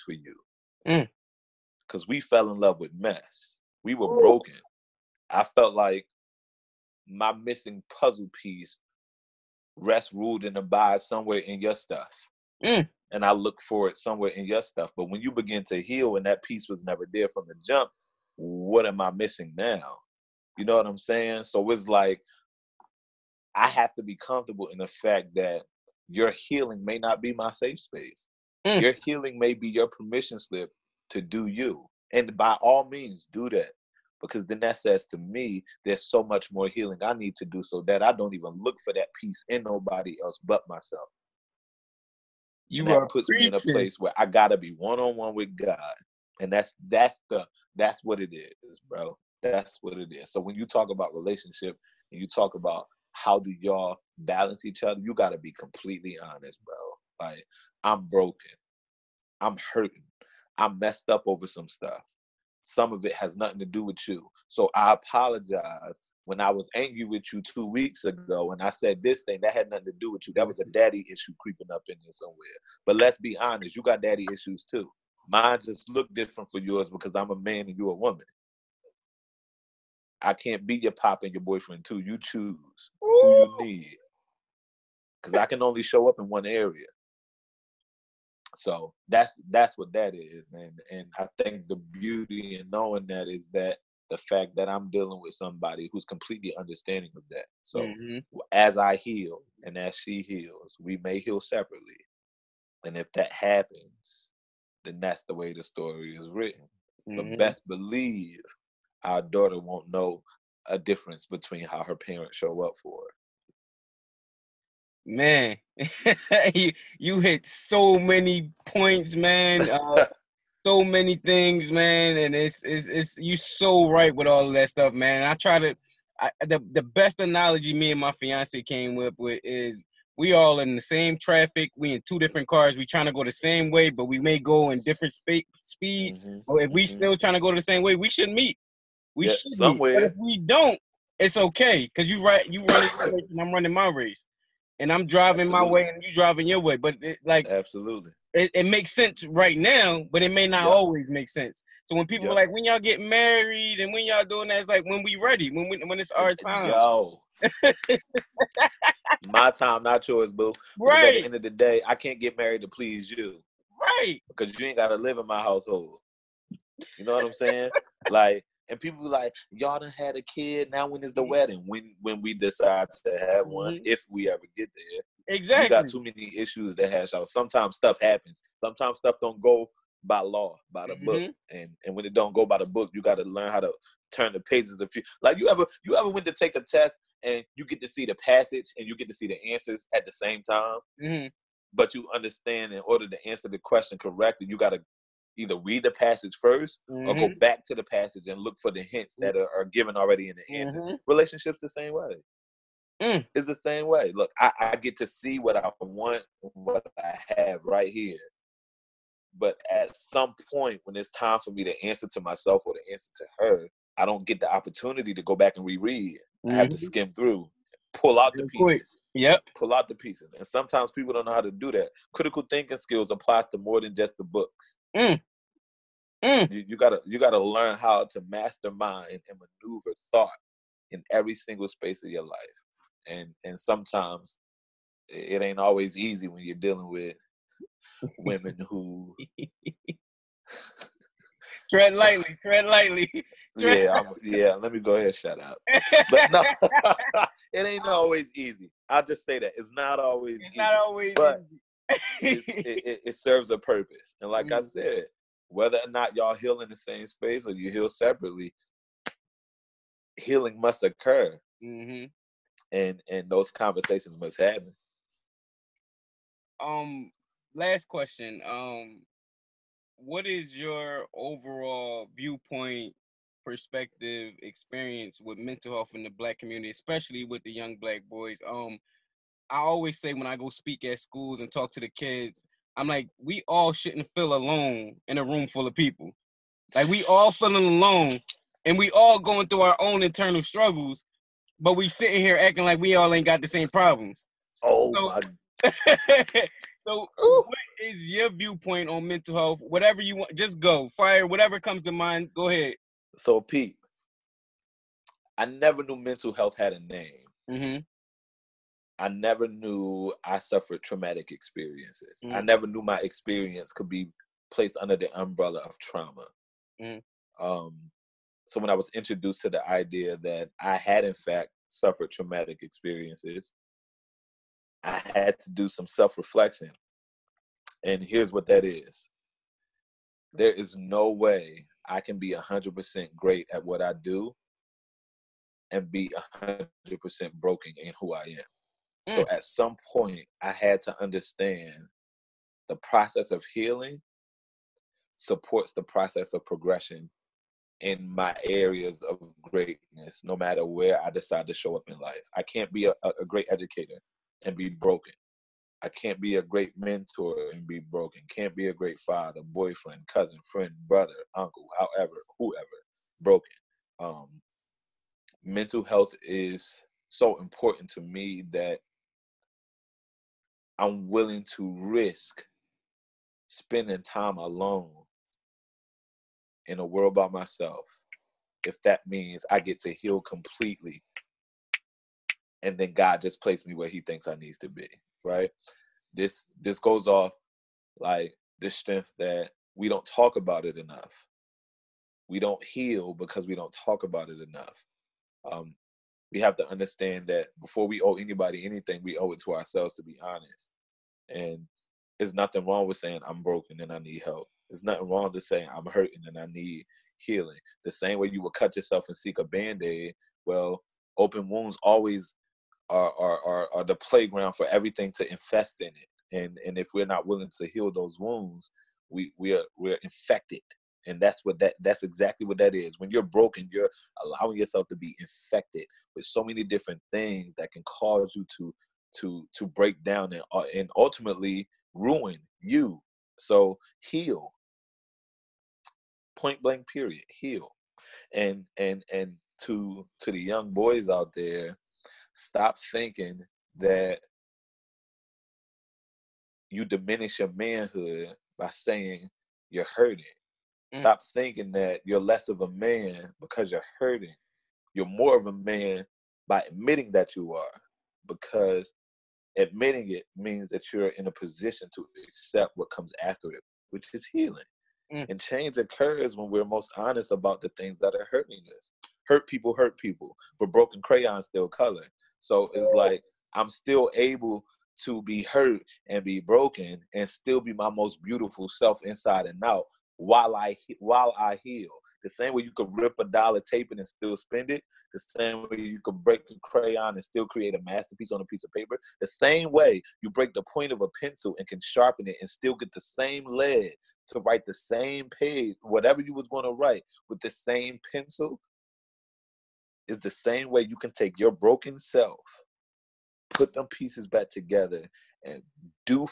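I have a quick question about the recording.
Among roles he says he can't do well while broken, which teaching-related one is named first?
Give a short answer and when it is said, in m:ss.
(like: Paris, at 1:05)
educator, at 5:53.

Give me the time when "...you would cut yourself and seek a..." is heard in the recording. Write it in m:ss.
6:48.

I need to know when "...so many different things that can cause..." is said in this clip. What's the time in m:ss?
7:06.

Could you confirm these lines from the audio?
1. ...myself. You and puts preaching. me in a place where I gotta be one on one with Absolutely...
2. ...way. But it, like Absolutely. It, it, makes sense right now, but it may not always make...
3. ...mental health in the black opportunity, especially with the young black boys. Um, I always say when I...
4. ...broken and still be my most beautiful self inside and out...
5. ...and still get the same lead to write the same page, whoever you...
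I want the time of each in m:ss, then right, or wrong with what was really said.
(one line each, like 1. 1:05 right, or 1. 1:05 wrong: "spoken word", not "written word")
1. 0:40 wrong: "God", not "Absolutely"
2. 2:26 right
3. 4:35 wrong: "community", not "opportunity"
4. 7:56 right
5. 8:12 wrong: "whatever", not "whoever".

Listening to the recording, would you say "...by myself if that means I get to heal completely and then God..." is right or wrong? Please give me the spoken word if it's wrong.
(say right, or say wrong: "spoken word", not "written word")
right.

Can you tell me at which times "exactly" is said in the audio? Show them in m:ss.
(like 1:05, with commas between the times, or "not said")
2:55, 7:02.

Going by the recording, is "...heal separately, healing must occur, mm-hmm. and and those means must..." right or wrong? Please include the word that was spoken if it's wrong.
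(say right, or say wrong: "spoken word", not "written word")
wrong: "conversations", not "means".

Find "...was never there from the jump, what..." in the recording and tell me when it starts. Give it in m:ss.
0:16.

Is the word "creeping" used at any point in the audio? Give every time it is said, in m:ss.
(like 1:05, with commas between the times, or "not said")
1:11.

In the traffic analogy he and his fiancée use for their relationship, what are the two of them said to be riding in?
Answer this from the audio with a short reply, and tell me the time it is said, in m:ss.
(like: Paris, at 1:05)
two different cars, at 2:12.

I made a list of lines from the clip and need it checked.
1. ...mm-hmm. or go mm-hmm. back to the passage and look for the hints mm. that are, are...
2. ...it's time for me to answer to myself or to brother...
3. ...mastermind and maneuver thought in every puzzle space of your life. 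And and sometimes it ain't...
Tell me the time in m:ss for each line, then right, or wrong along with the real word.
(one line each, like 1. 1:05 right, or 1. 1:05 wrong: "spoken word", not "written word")
1. 3:16 right
2. 3:30 wrong: "answer", not "brother"
3. 3:48 wrong: "single", not "puzzle".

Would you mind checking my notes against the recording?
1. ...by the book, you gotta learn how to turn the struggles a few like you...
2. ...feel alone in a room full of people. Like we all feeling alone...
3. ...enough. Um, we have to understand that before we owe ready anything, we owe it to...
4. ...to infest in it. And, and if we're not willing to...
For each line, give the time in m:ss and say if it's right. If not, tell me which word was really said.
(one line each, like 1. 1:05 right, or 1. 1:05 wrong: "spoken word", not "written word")
1. 3:02 wrong: "pages", not "struggles"
2. 4:44 right
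3. 6:34 wrong: "anybody", not "ready"
4. 6:55 right.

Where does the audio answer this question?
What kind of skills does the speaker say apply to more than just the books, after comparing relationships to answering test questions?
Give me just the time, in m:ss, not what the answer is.
3:42.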